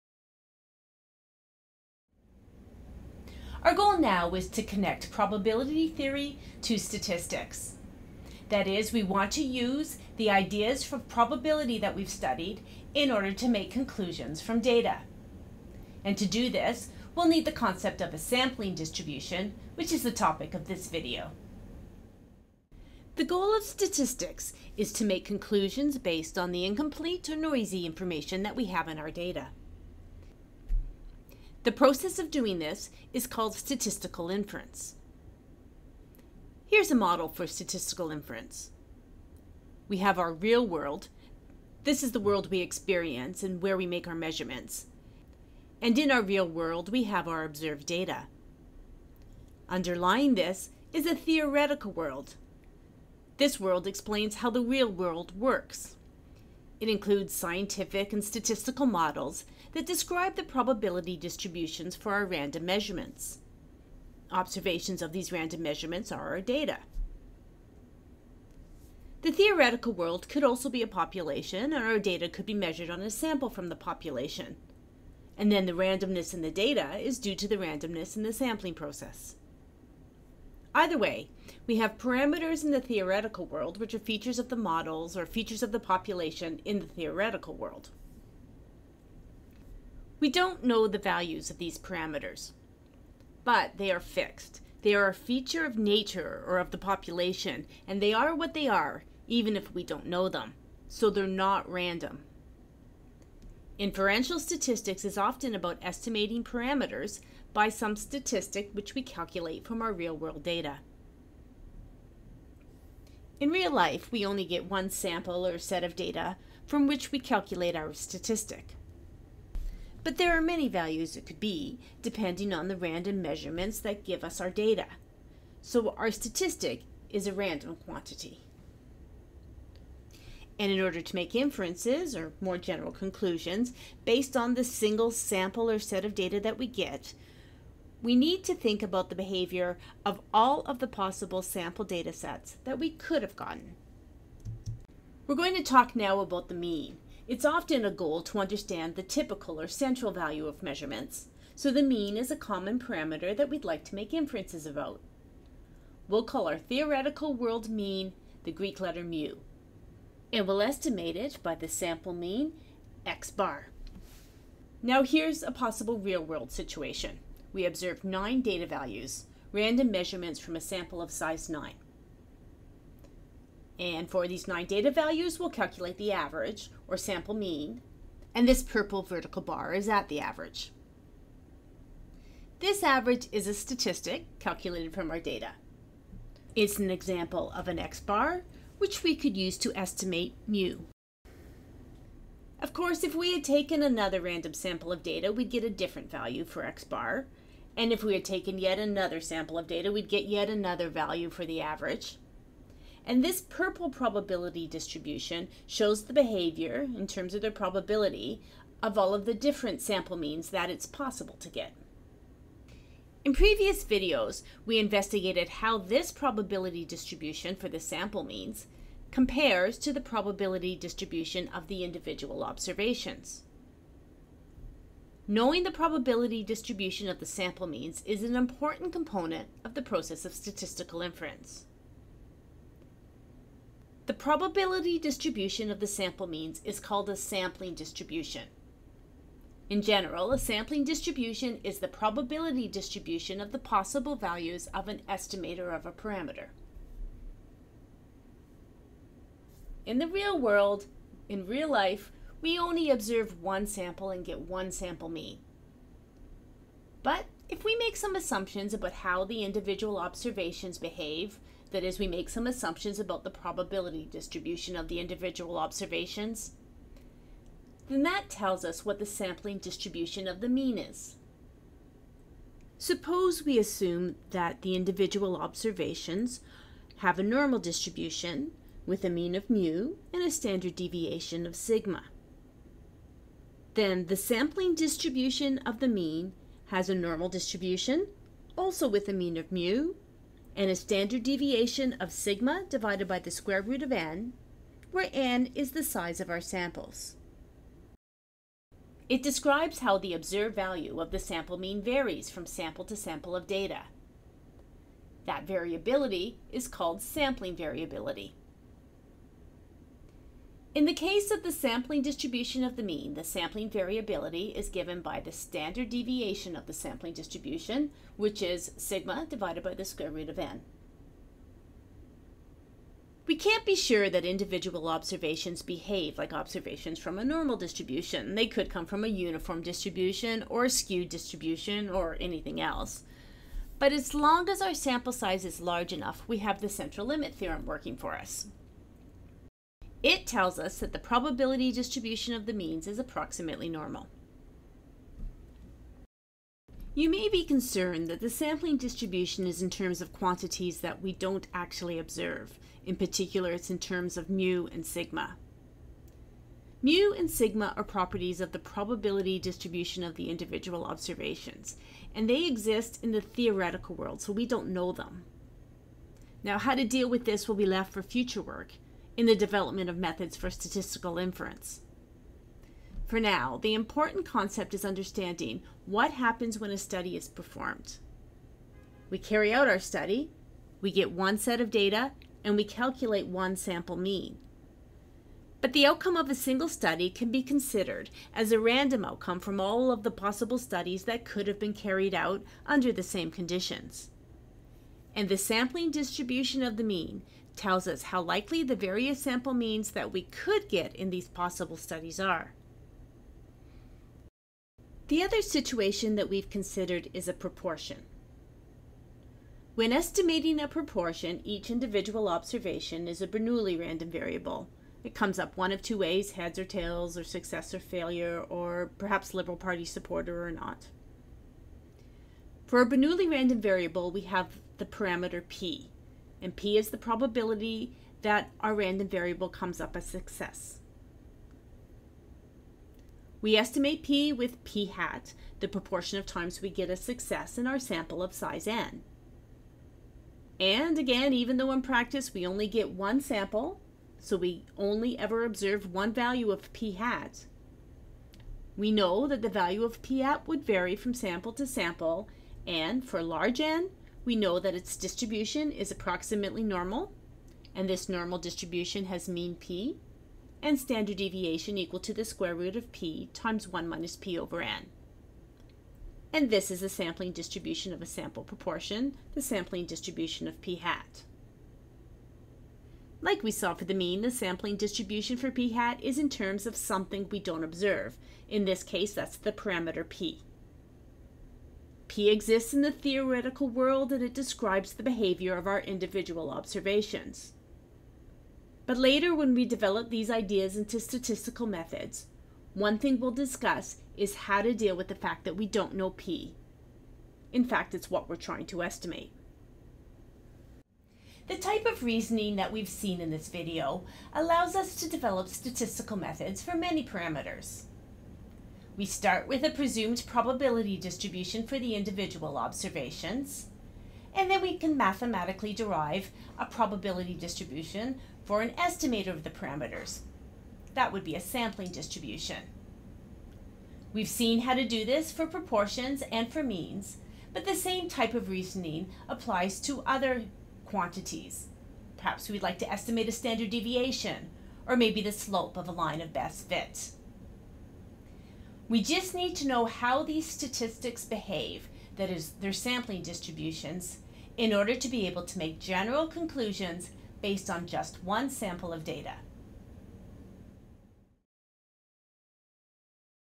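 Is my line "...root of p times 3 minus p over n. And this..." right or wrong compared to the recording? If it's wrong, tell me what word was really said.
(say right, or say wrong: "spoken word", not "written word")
wrong: "1", not "3".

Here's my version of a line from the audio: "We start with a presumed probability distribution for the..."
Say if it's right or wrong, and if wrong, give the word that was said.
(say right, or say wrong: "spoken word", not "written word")
right.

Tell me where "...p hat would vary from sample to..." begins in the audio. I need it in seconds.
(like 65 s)
450 s.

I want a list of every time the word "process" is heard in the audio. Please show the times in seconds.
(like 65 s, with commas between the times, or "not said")
31 s, 78 s, 229 s.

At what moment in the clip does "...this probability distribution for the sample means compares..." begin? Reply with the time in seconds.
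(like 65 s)
215 s.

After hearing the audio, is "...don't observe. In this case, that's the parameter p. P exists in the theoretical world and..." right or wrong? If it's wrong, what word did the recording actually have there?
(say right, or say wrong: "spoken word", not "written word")
right.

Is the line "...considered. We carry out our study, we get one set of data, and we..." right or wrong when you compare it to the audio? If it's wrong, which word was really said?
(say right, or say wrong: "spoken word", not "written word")
wrong: "performed", not "considered".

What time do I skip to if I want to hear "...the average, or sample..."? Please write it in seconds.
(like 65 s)
175 s.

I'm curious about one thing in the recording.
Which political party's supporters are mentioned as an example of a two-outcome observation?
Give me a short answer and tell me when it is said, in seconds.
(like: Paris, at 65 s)
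Liberal Party, at 419 s.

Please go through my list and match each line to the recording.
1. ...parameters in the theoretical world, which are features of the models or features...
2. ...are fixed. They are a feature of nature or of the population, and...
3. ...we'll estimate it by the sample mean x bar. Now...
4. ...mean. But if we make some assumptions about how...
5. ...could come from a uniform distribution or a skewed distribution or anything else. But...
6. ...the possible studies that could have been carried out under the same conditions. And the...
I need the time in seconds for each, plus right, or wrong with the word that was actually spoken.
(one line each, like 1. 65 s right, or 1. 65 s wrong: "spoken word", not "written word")
1. 81 s right
2. 93 s right
3. 160 s right
4. 255 s right
5. 328 s right
6. 390 s right.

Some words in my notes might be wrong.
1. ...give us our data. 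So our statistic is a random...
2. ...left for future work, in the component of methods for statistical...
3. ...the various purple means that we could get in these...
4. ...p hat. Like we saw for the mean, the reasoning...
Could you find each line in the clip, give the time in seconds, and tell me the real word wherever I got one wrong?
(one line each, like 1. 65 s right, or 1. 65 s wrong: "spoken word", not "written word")
1. 124 s right
2. 367 s wrong: "development", not "component"
3. 398 s wrong: "sample", not "purple"
4. 470 s wrong: "sampling", not "reasoning".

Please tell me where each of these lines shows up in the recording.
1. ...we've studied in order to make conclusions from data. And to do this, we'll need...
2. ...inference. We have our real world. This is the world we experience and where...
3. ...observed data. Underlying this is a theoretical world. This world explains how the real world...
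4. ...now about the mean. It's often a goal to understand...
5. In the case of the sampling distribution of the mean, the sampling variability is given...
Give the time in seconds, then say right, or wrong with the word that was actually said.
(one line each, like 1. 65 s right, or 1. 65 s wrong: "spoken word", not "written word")
1. 11 s right
2. 38 s right
3. 47 s right
4. 145 s right
5. 310 s right.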